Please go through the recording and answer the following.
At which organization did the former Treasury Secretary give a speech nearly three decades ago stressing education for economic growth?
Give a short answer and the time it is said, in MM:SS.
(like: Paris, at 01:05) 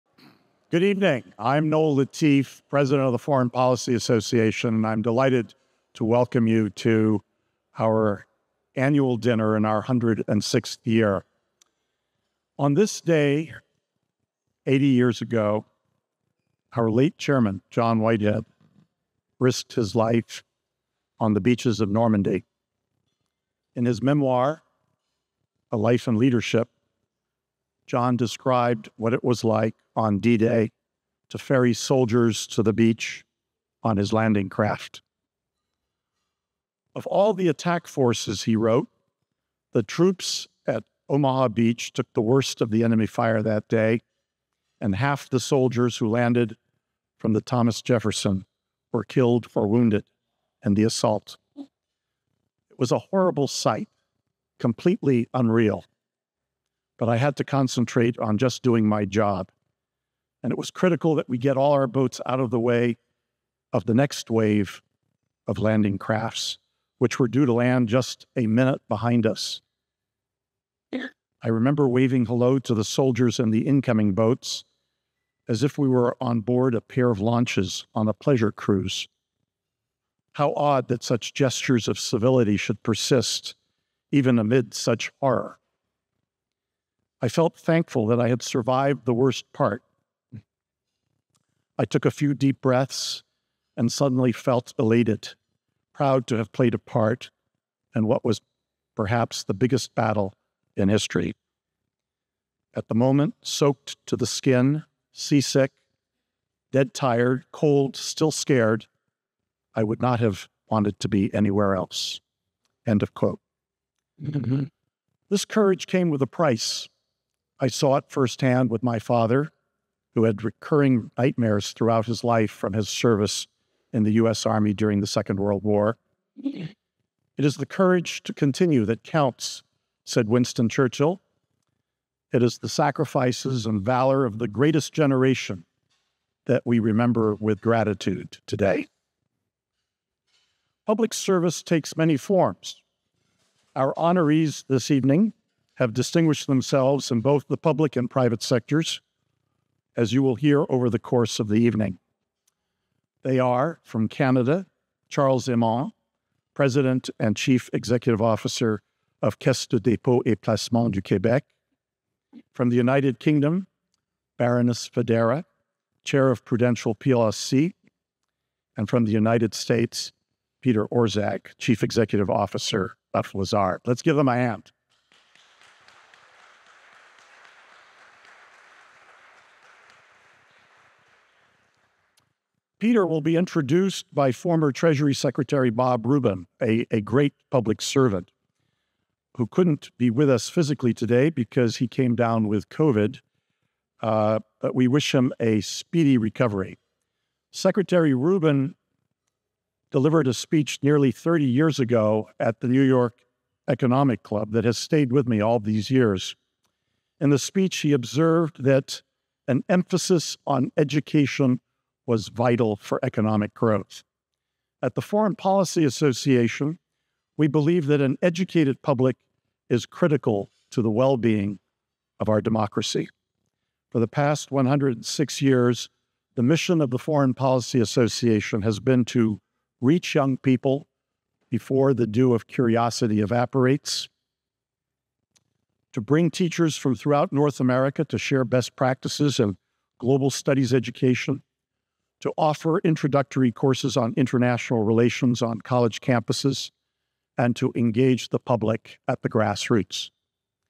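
New York Economic Club, at 03:22.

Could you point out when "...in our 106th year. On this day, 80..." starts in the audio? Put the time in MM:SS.
00:09.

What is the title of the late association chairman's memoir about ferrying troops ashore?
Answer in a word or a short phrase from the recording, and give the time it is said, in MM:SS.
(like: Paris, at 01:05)
A Life in Leadership, at 00:25.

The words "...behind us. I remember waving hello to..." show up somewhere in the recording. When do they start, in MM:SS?
01:08.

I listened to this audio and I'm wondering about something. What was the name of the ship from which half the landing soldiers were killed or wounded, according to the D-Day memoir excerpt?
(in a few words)
Thomas Jefferson.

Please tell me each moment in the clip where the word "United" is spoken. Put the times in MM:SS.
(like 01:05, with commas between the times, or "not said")
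02:42, 02:49.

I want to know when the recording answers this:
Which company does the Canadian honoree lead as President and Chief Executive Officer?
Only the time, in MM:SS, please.
02:39.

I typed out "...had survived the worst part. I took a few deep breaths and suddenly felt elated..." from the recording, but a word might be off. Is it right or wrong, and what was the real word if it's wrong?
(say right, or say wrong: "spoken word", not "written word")
right.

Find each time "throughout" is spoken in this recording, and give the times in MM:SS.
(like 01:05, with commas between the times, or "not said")
02:01, 03:56.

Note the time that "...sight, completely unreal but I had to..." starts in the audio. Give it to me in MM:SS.
00:53.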